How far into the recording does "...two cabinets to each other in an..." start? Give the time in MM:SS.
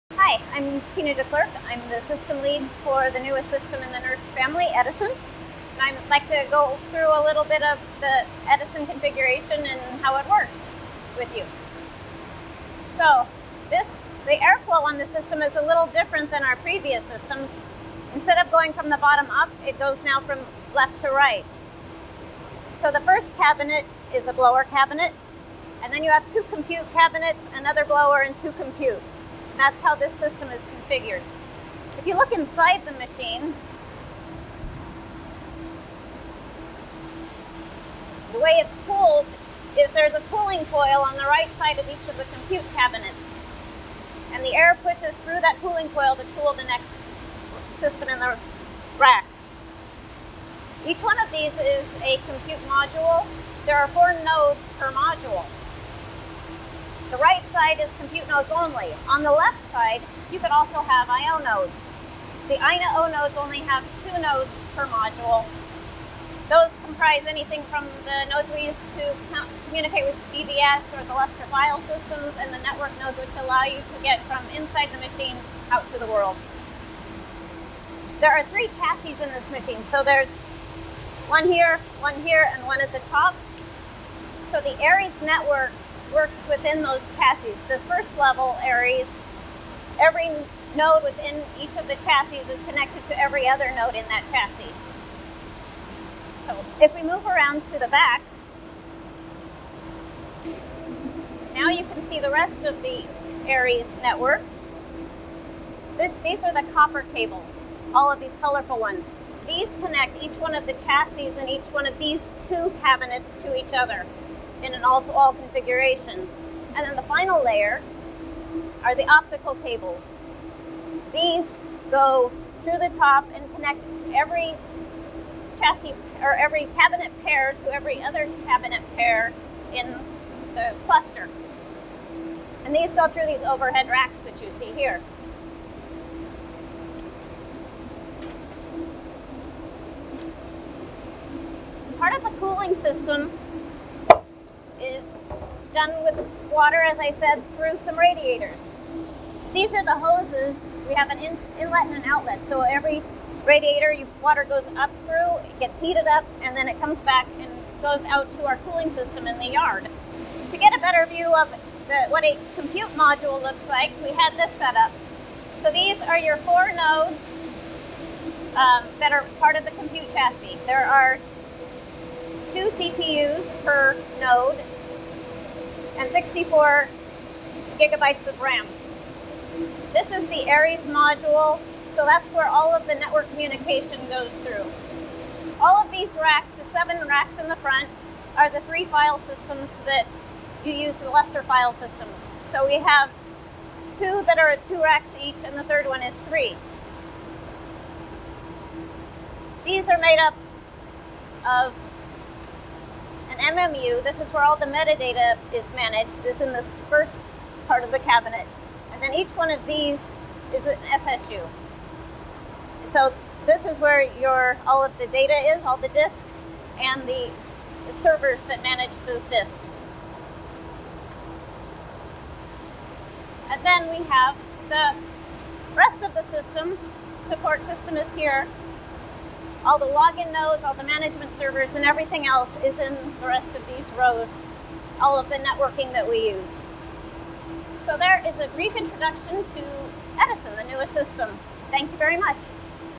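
01:52.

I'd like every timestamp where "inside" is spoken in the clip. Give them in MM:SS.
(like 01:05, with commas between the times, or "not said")
00:32, 01:14.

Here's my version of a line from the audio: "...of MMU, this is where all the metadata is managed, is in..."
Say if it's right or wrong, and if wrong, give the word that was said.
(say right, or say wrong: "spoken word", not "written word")
right.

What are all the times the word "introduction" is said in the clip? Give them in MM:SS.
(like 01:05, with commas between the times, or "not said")
03:58.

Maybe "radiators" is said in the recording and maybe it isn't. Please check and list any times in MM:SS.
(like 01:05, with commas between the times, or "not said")
02:27, 02:33.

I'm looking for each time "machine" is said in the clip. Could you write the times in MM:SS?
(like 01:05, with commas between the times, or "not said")
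00:32, 01:15, 01:19.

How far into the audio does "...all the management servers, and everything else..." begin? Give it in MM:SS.
03:50.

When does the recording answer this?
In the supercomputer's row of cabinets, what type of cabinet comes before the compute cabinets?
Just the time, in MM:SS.
00:24.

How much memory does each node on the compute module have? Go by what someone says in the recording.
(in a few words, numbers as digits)
64 GB.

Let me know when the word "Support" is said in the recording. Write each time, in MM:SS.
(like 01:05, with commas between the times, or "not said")
03:47.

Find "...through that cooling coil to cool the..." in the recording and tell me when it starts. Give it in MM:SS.
00:45.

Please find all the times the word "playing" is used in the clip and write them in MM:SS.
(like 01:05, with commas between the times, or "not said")
not said.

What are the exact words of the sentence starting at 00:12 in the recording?
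So this, the airflow on the system is a little different than our previous systems.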